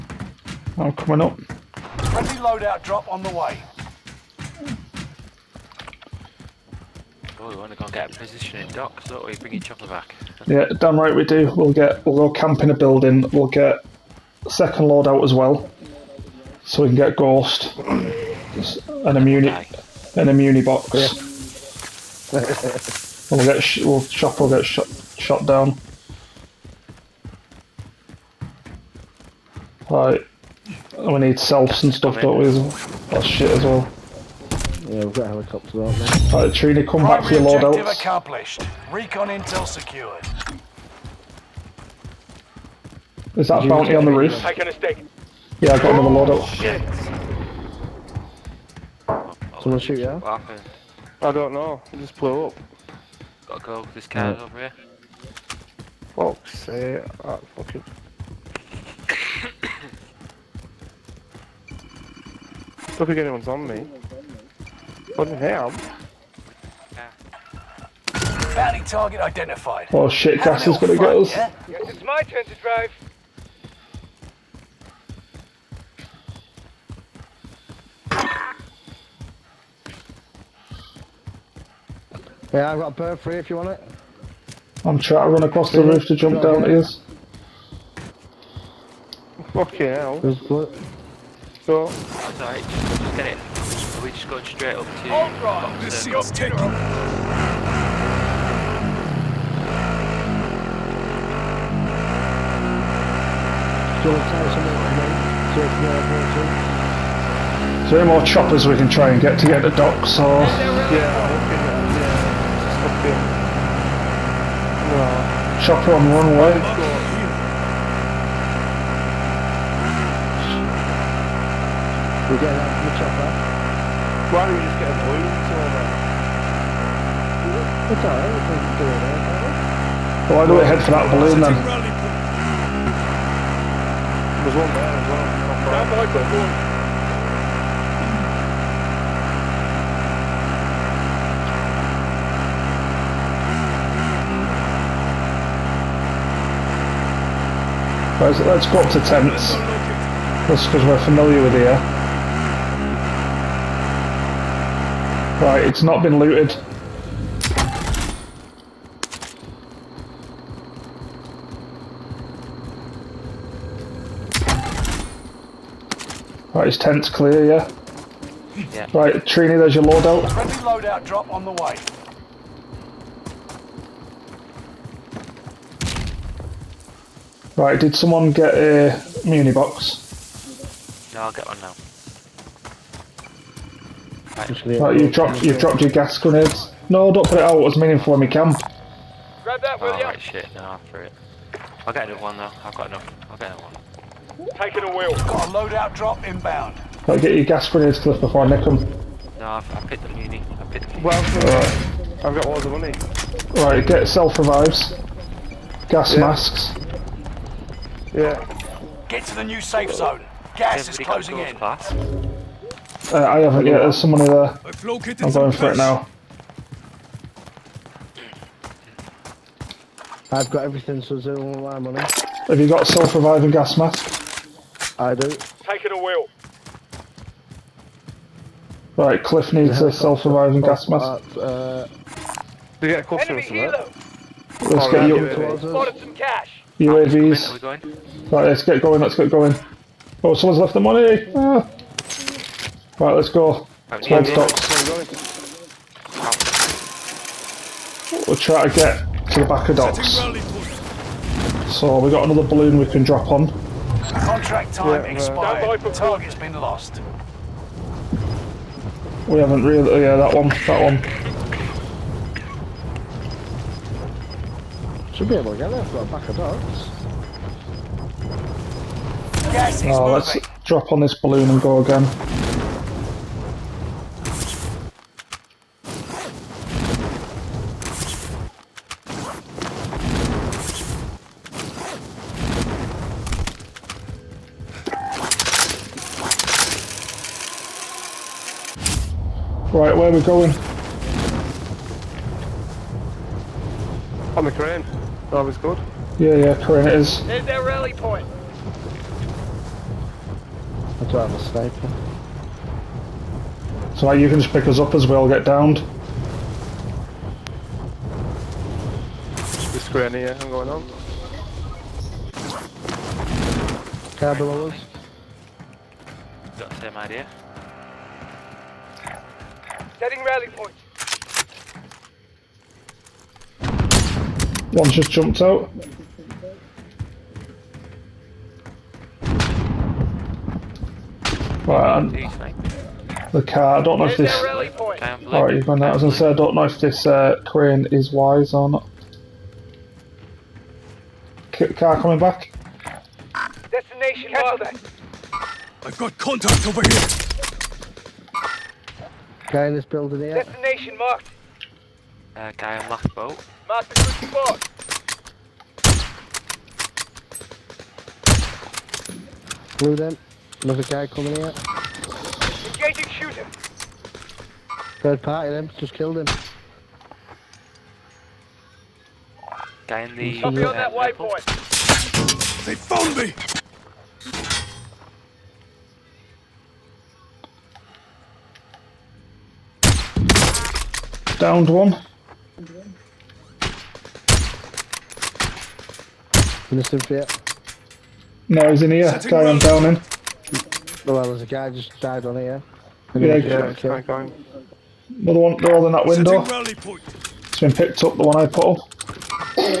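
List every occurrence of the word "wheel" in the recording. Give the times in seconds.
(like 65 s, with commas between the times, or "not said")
194 s, 225 s.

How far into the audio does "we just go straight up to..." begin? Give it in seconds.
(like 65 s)
94 s.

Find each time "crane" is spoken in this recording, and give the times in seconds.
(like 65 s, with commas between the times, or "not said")
294 s, 337 s.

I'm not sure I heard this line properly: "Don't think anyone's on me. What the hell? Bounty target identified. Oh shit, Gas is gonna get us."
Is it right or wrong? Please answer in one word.
right.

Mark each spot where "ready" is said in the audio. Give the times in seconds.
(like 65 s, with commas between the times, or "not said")
not said.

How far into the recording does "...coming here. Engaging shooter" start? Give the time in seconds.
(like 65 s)
361 s.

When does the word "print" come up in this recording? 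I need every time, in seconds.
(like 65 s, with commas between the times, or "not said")
not said.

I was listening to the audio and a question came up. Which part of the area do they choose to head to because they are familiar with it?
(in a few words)
Tents.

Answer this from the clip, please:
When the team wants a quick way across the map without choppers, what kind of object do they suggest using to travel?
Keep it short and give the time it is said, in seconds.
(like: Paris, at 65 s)
A balloon, at 124 s.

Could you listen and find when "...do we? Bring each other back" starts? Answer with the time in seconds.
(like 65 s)
9 s.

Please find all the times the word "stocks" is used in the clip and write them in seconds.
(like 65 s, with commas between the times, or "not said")
244 s.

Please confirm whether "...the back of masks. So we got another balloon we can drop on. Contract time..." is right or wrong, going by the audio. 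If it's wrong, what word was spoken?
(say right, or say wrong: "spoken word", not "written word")
wrong: "docks", not "masks".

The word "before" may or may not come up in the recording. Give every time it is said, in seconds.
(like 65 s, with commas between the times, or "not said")
198 s.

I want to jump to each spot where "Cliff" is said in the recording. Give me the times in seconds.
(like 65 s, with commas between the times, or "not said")
197 s, 229 s.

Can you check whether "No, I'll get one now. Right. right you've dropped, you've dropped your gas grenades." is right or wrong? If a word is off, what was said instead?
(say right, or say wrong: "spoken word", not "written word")
right.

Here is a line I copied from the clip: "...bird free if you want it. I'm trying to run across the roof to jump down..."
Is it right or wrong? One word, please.
right.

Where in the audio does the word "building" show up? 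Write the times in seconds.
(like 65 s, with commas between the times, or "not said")
12 s, 349 s.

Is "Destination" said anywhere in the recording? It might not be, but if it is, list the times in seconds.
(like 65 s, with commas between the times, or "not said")
343 s, 350 s.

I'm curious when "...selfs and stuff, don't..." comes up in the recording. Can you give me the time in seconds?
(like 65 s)
31 s.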